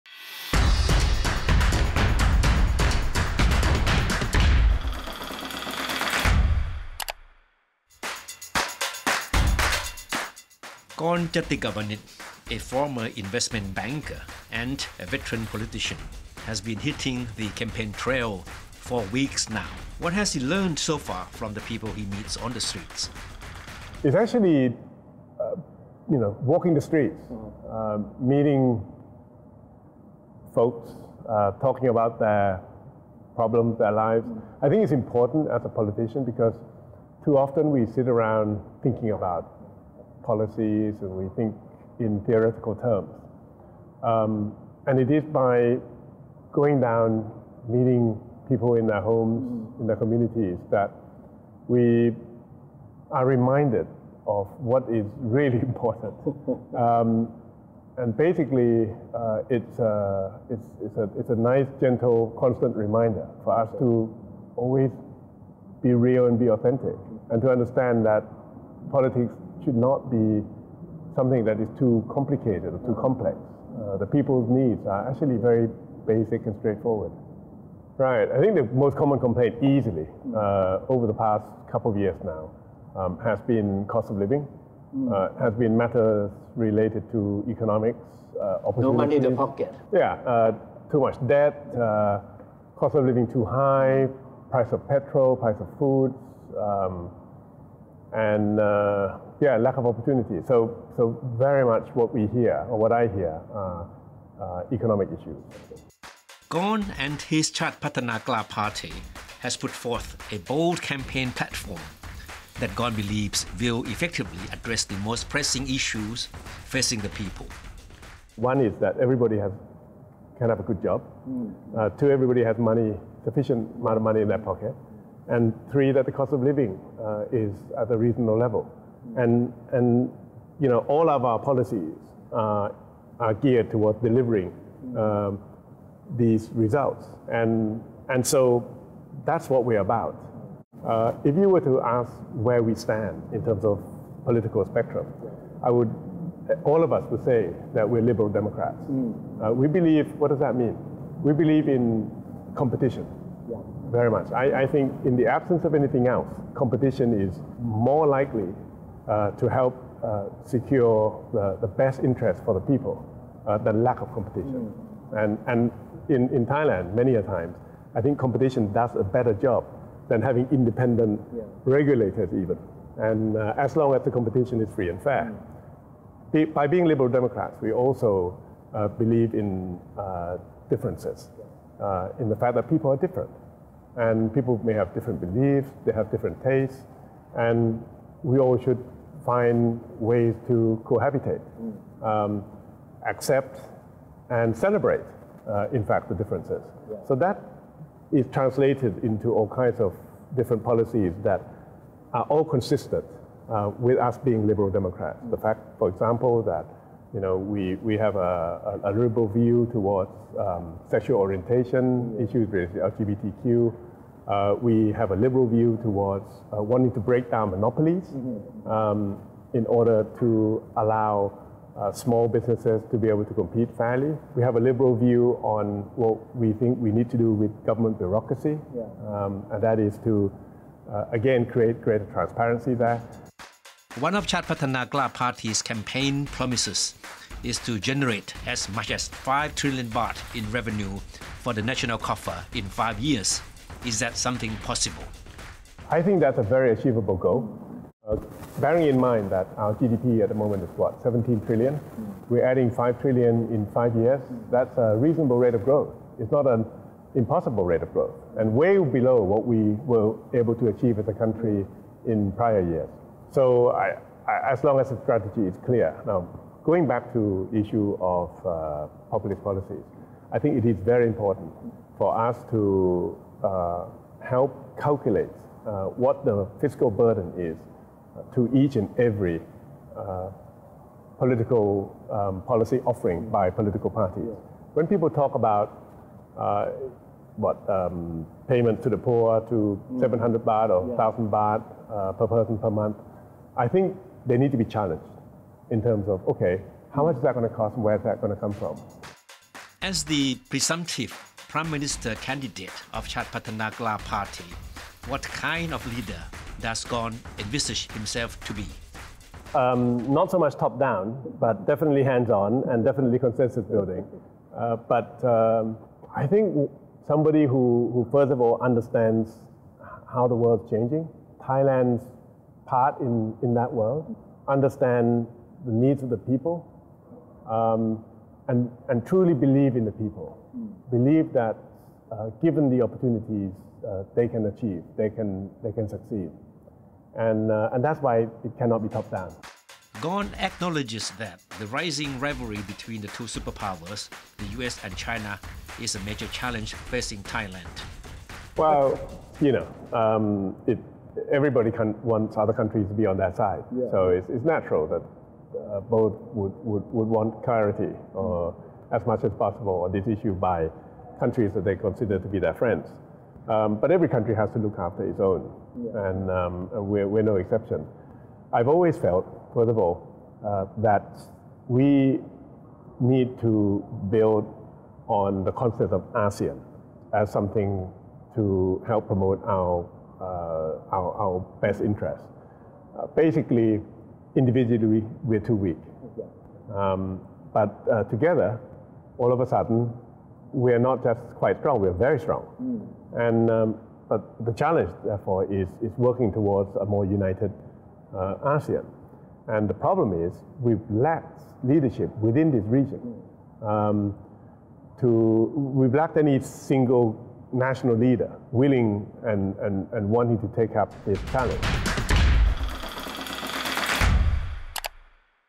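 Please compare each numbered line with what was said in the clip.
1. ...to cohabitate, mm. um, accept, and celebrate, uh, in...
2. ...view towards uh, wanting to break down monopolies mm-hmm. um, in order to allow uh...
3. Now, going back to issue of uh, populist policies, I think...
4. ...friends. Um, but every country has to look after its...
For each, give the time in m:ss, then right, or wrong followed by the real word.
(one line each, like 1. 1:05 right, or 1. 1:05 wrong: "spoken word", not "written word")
1. 3:10 right
2. 3:35 right
3. 4:26 right
4. 6:02 right.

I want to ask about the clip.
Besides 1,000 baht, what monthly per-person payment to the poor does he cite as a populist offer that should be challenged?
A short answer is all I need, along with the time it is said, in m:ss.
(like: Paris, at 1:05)
700 baht, at 4:49.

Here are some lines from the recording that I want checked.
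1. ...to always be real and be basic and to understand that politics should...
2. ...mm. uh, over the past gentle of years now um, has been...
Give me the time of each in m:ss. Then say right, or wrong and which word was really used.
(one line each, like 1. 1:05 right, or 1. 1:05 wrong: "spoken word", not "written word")
1. 1:03 wrong: "authentic", not "basic"
2. 1:20 wrong: "couple", not "gentle".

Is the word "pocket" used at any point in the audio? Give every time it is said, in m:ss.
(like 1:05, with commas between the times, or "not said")
1:29, 2:04.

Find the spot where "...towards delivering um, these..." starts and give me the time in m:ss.
2:13.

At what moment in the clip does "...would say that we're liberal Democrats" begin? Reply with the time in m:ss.
2:27.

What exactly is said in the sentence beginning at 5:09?
Um, not so much top down, but definitely hands on and definitely consensus building.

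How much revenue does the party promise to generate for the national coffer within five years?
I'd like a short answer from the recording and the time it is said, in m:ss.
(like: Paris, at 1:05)
5 trillion baht, at 3:59.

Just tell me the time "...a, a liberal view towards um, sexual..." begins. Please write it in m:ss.
3:28.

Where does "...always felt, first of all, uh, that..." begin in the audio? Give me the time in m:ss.
6:08.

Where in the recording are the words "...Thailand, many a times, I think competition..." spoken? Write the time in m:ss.
2:46.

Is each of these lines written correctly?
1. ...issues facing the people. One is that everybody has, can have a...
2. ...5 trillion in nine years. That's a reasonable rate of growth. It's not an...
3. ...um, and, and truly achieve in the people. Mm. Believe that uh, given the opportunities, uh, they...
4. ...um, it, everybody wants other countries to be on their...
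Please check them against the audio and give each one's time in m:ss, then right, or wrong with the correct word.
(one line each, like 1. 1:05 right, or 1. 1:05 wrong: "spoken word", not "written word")
1. 1:55 right
2. 4:12 wrong: "five", not "nine"
3. 5:27 wrong: "believe", not "achieve"
4. 5:49 right.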